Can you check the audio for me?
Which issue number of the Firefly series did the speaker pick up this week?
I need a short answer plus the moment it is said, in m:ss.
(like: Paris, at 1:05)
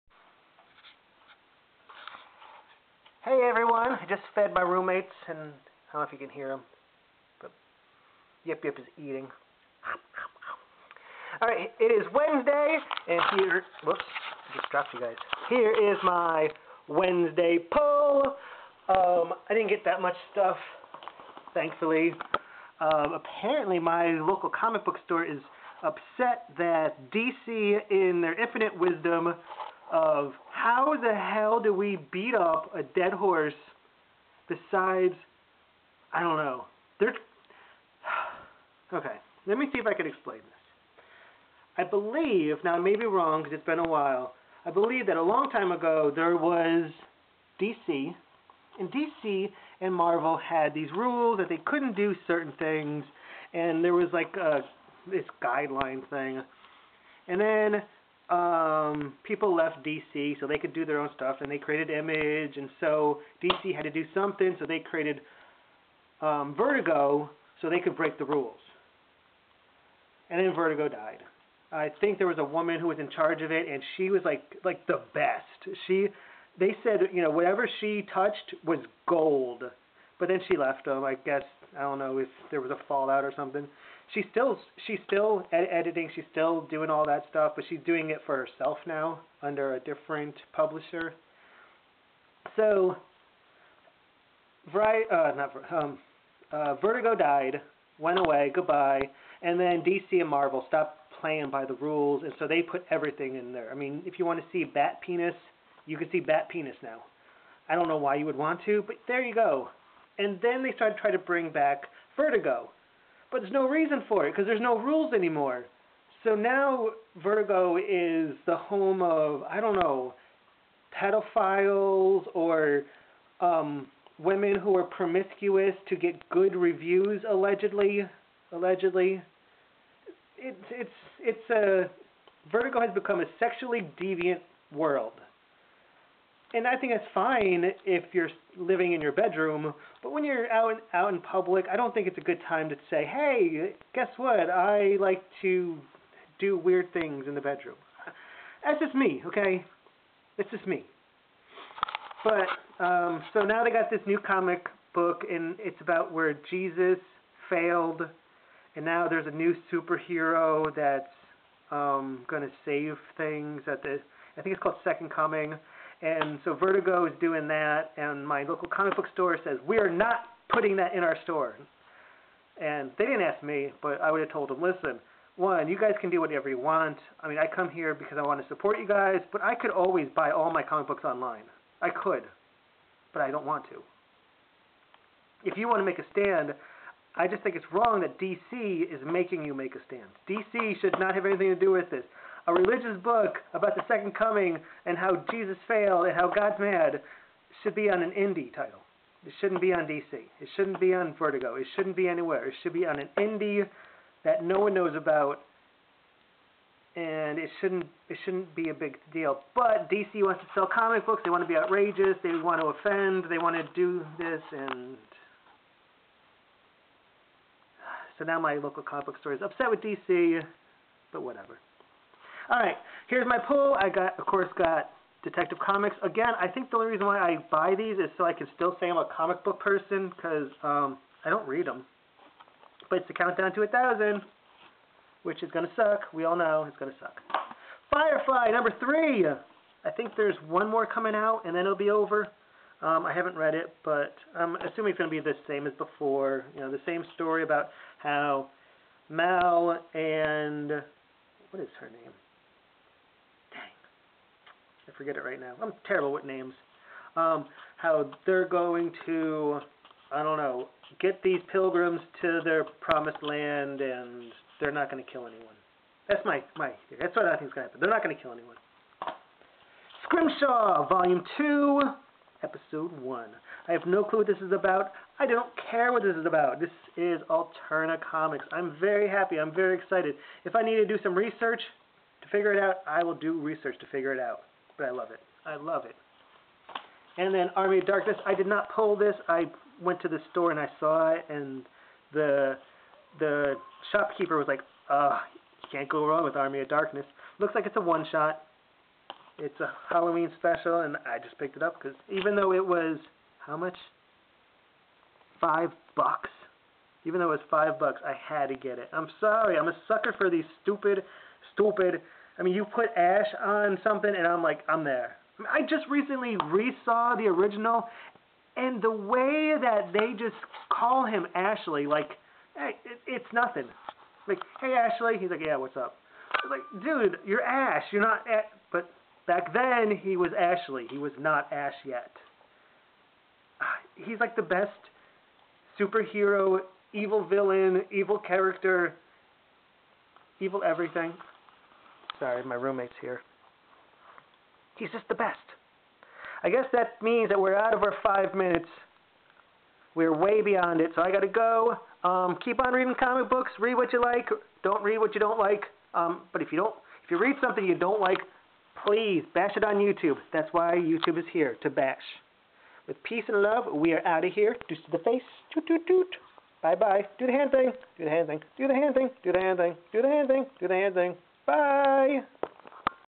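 3, at 3:57.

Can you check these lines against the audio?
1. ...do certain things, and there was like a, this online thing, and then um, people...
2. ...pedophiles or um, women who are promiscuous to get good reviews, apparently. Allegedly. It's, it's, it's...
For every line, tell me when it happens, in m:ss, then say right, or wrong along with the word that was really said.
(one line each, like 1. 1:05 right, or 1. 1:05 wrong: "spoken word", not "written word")
1. 0:51 wrong: "guideline", not "online"
2. 2:01 wrong: "allegedly", not "apparently".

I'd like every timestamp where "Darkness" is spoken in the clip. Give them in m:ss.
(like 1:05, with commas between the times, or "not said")
4:47, 4:56.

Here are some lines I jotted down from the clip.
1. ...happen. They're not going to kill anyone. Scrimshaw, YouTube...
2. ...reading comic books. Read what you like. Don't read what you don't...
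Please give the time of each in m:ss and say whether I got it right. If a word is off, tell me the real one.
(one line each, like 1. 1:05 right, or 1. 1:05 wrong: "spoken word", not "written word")
1. 4:27 wrong: "Volume", not "YouTube"
2. 5:52 right.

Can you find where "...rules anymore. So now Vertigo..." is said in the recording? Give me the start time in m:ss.
1:54.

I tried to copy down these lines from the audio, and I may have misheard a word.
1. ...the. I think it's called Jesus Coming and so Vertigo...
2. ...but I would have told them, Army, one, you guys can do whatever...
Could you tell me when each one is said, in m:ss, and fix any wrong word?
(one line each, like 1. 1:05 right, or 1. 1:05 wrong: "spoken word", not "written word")
1. 2:43 wrong: "Second", not "Jesus"
2. 2:53 wrong: "Listen", not "Army".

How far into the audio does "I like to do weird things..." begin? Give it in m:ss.
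2:24.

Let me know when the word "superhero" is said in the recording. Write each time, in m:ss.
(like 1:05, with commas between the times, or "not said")
2:39, 5:35.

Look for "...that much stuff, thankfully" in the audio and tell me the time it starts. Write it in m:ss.
0:19.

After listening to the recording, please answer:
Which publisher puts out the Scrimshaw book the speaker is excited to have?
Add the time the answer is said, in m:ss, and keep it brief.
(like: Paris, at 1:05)
Alterna Comics, at 4:37.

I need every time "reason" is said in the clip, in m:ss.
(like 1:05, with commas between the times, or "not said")
1:53, 3:46.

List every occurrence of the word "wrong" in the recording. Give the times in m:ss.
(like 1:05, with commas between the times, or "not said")
0:43, 3:07, 4:56.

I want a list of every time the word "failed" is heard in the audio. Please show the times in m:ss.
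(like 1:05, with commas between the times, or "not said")
2:37, 3:15.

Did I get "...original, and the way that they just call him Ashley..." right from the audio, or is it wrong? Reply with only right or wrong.
right.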